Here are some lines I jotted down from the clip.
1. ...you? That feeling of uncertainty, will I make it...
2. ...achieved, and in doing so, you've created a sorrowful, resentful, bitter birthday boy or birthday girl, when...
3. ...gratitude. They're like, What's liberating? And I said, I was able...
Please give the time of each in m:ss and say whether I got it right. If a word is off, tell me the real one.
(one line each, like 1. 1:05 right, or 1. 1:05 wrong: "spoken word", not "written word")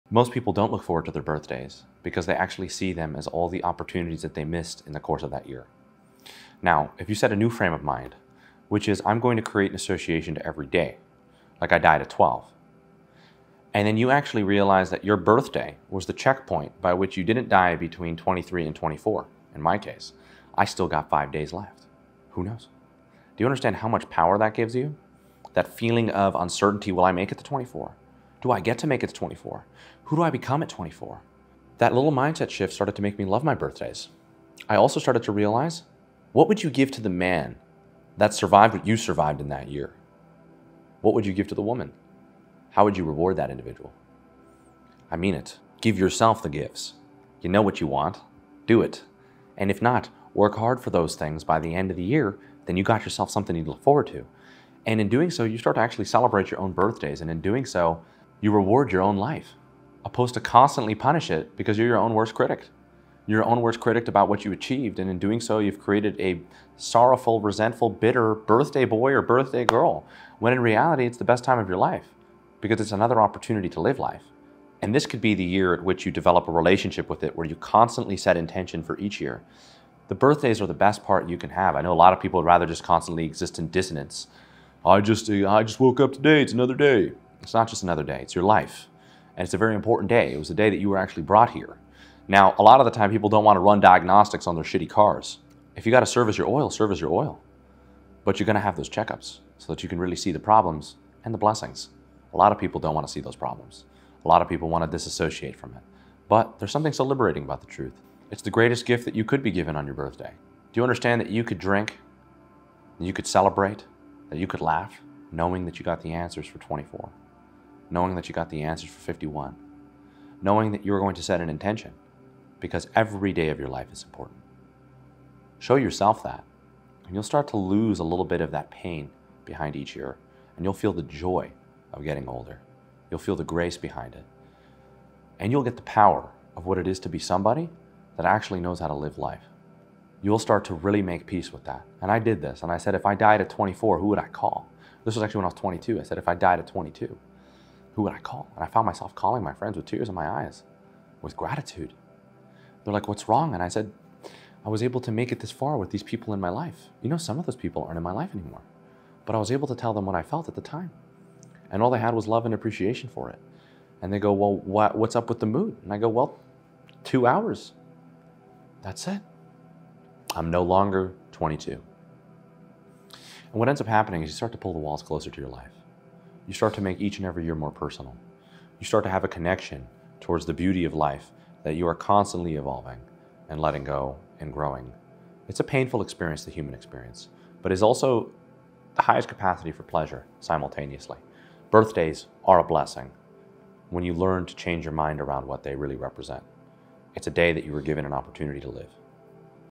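1. 0:24 right
2. 1:04 right
3. 2:31 wrong: "wrong", not "liberating".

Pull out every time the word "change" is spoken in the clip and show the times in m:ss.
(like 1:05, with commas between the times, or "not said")
3:14.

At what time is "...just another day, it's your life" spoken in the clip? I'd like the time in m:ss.
1:27.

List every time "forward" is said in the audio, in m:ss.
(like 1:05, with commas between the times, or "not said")
0:00, 0:53.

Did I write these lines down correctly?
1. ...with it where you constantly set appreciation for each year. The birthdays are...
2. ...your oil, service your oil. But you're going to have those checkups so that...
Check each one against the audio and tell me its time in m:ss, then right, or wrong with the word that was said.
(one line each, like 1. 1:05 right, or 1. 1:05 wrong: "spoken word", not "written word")
1. 1:17 wrong: "intention", not "appreciation"
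2. 1:36 right.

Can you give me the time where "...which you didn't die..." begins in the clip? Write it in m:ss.
0:16.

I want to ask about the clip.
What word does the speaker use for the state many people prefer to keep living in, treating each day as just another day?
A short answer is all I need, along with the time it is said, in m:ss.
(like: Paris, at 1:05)
dissonance, at 1:23.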